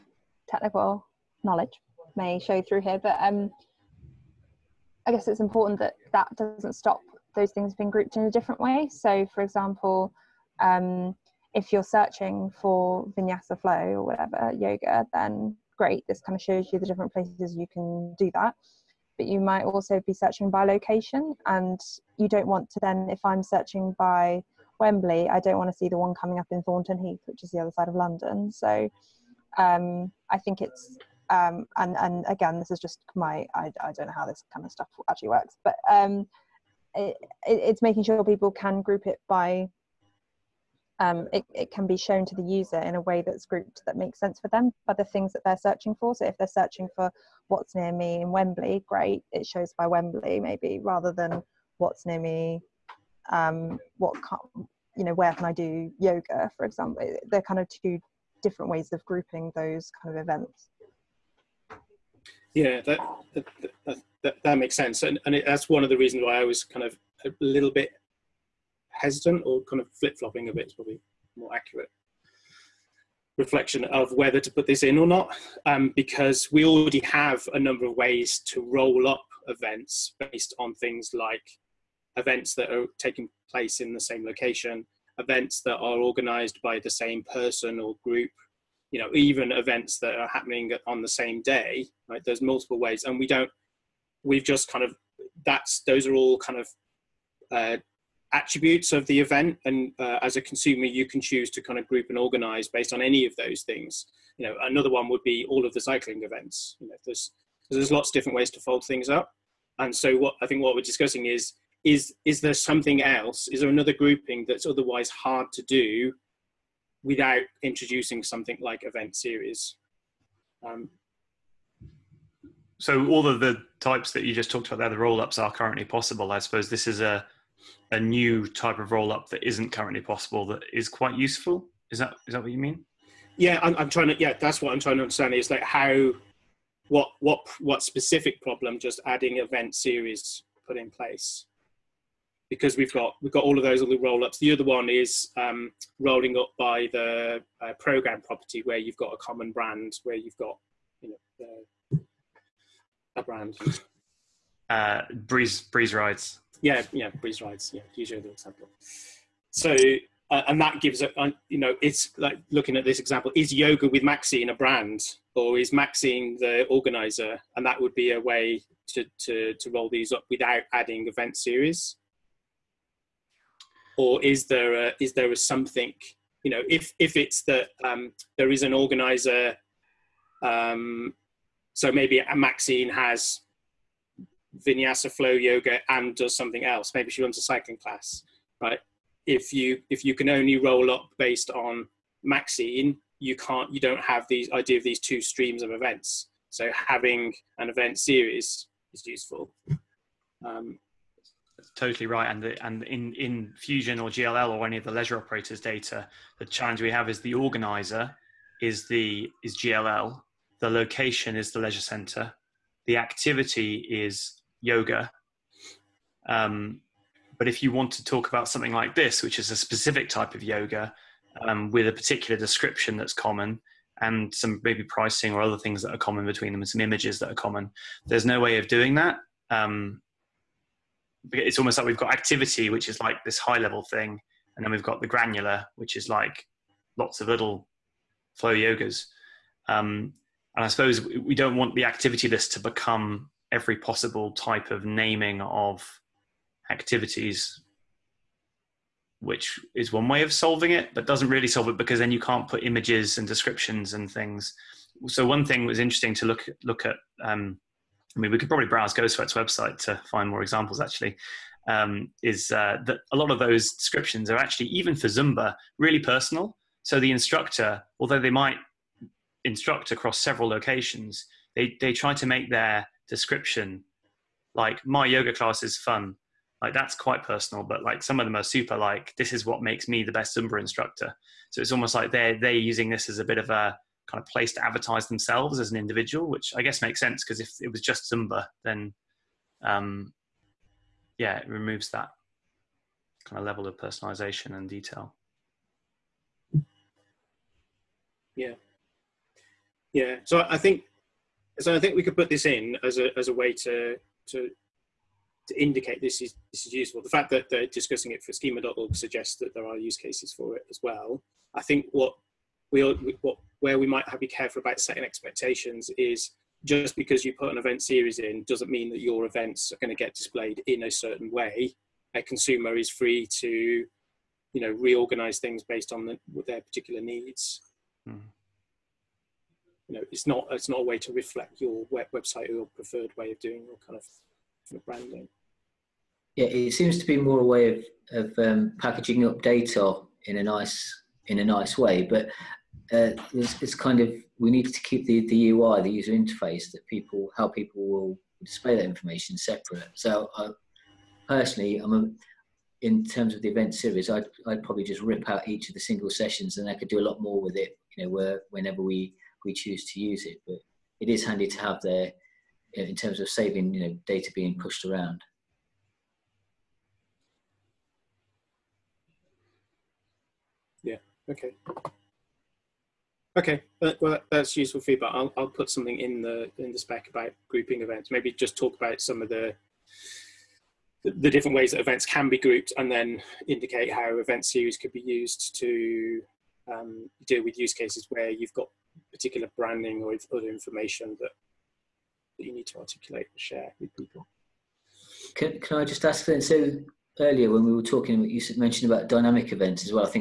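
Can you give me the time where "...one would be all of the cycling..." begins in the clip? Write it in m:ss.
1:44.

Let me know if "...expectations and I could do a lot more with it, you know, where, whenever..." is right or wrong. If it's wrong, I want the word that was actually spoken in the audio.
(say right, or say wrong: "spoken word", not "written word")
wrong: "sessions", not "expectations".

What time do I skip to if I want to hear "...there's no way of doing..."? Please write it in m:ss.
3:48.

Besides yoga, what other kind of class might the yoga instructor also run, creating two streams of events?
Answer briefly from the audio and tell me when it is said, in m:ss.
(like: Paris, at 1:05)
cycling class, at 3:07.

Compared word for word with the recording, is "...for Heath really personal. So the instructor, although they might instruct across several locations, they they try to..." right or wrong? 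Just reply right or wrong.
wrong.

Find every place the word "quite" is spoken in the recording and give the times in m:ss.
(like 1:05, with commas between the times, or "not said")
2:10, 4:36.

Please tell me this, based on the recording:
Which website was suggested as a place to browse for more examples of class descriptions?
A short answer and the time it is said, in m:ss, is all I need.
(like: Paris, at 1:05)
GoSweat, at 4:18.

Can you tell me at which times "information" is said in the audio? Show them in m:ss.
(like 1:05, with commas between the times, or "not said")
5:48, 6:30.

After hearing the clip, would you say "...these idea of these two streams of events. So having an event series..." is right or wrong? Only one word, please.
right.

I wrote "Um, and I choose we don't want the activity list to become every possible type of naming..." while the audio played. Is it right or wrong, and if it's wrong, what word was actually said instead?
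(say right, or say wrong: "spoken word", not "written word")
wrong: "suppose", not "choose".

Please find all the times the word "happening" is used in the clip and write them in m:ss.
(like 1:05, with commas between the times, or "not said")
1:30.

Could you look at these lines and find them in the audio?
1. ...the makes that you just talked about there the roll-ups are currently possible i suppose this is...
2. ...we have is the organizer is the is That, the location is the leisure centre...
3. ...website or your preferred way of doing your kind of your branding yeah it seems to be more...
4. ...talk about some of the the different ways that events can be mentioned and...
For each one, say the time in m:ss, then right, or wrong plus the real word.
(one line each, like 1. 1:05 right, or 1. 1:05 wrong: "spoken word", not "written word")
1. 2:03 wrong: "types", not "makes"
2. 3:26 wrong: "GLL", not "That"
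3. 5:32 right
4. 6:18 wrong: "grouped", not "mentioned".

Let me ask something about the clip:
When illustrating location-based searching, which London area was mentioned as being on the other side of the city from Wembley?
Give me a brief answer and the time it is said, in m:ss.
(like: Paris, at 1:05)
Thornton Heath, at 0:26.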